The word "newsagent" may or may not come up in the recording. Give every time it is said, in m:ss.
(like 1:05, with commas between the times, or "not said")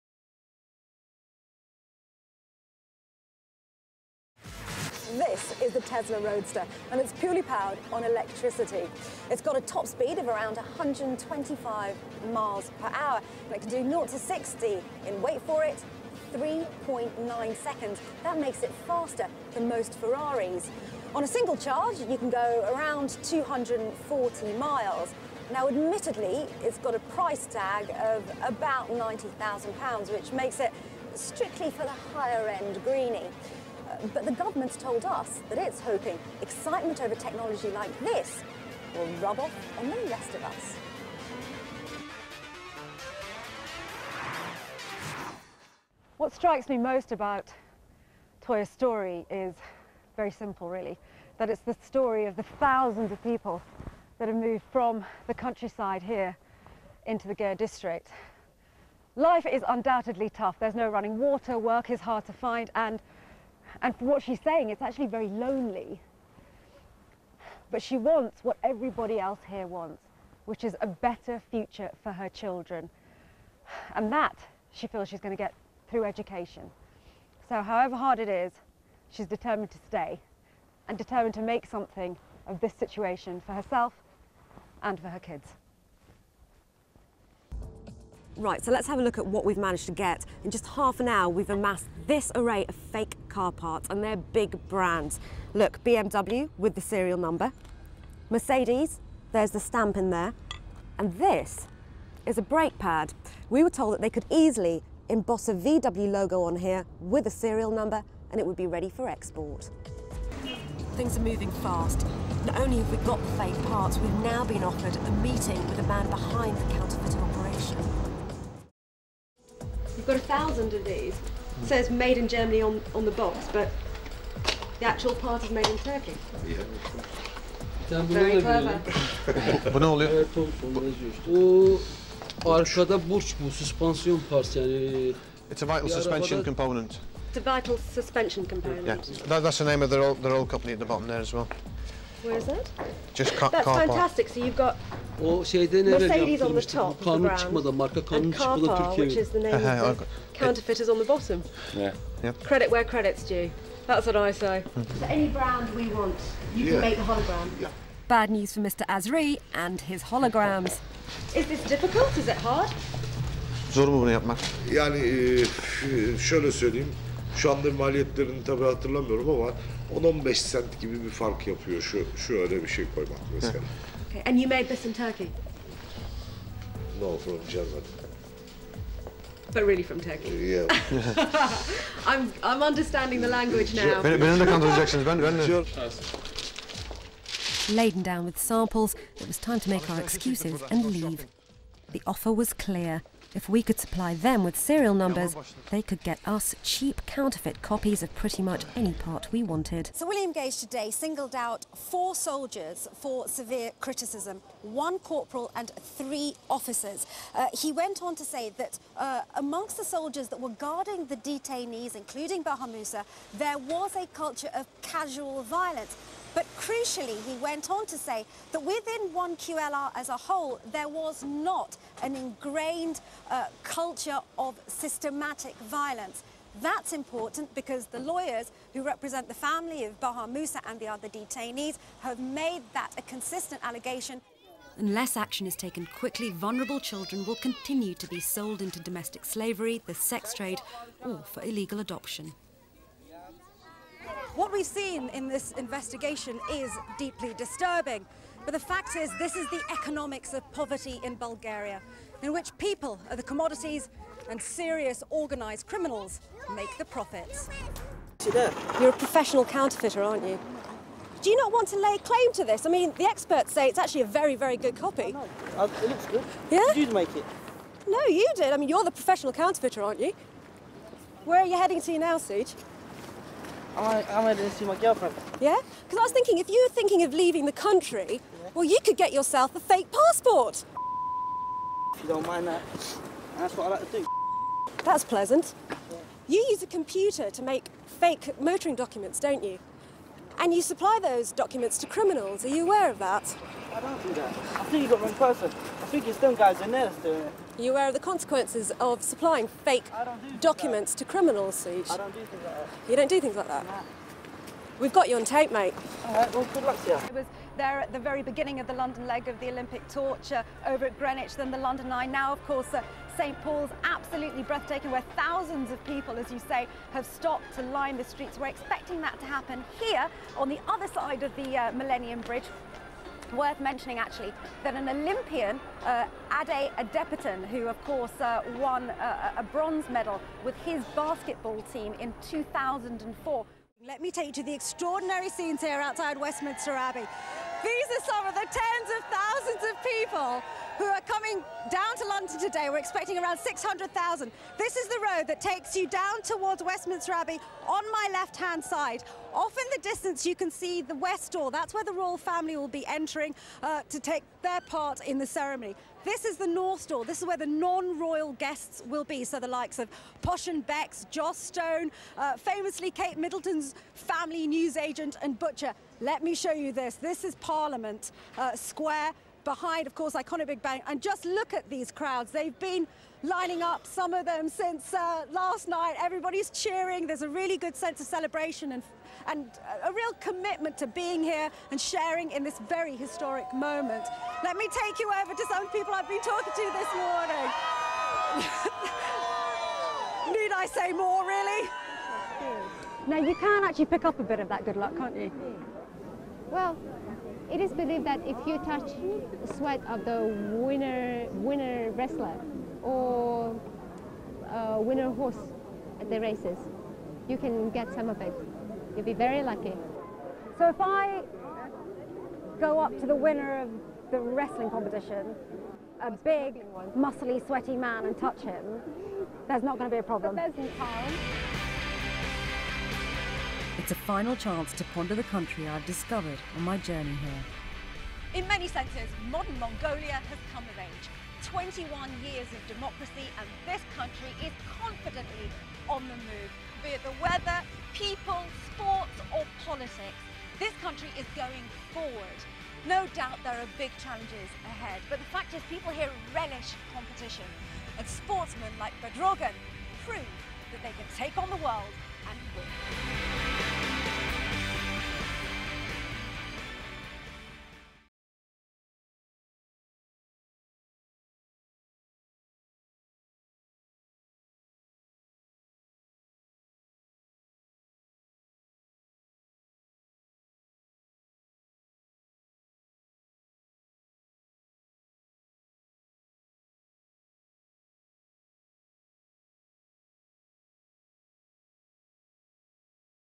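6:04.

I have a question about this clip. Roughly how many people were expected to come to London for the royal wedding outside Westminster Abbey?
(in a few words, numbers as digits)
600,000.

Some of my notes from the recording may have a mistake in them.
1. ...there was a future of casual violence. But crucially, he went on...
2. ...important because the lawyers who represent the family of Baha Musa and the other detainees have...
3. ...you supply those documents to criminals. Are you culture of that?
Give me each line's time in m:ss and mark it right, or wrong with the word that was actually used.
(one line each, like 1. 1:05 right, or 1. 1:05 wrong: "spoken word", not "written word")
1. 3:33 wrong: "culture", not "future"
2. 3:46 right
3. 4:50 wrong: "aware", not "culture".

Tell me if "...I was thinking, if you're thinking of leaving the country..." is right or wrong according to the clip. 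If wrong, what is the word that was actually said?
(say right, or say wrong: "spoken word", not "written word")
right.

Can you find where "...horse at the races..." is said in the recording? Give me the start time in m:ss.
6:45.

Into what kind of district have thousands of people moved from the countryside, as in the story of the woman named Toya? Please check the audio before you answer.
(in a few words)
ger district.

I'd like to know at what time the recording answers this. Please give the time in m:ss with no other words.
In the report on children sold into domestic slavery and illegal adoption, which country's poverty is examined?
4:11.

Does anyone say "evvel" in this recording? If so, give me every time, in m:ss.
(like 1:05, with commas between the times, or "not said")
2:25.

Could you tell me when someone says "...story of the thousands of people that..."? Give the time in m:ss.
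0:51.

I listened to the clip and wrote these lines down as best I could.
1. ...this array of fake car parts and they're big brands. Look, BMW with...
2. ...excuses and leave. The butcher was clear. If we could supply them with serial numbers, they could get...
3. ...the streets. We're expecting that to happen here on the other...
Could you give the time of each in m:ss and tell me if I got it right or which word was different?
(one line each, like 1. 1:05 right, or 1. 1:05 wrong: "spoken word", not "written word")
1. 1:32 right
2. 3:10 wrong: "offer", not "butcher"
3. 5:17 right.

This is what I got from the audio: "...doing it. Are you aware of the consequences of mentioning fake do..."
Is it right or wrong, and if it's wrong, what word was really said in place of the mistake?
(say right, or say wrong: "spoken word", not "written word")
wrong: "supplying", not "mentioning".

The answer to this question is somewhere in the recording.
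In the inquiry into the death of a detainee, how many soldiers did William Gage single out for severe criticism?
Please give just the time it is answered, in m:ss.
3:21.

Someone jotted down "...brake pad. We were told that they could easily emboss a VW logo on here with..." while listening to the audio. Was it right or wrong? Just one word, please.
right.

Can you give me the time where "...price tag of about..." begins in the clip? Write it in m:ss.
0:27.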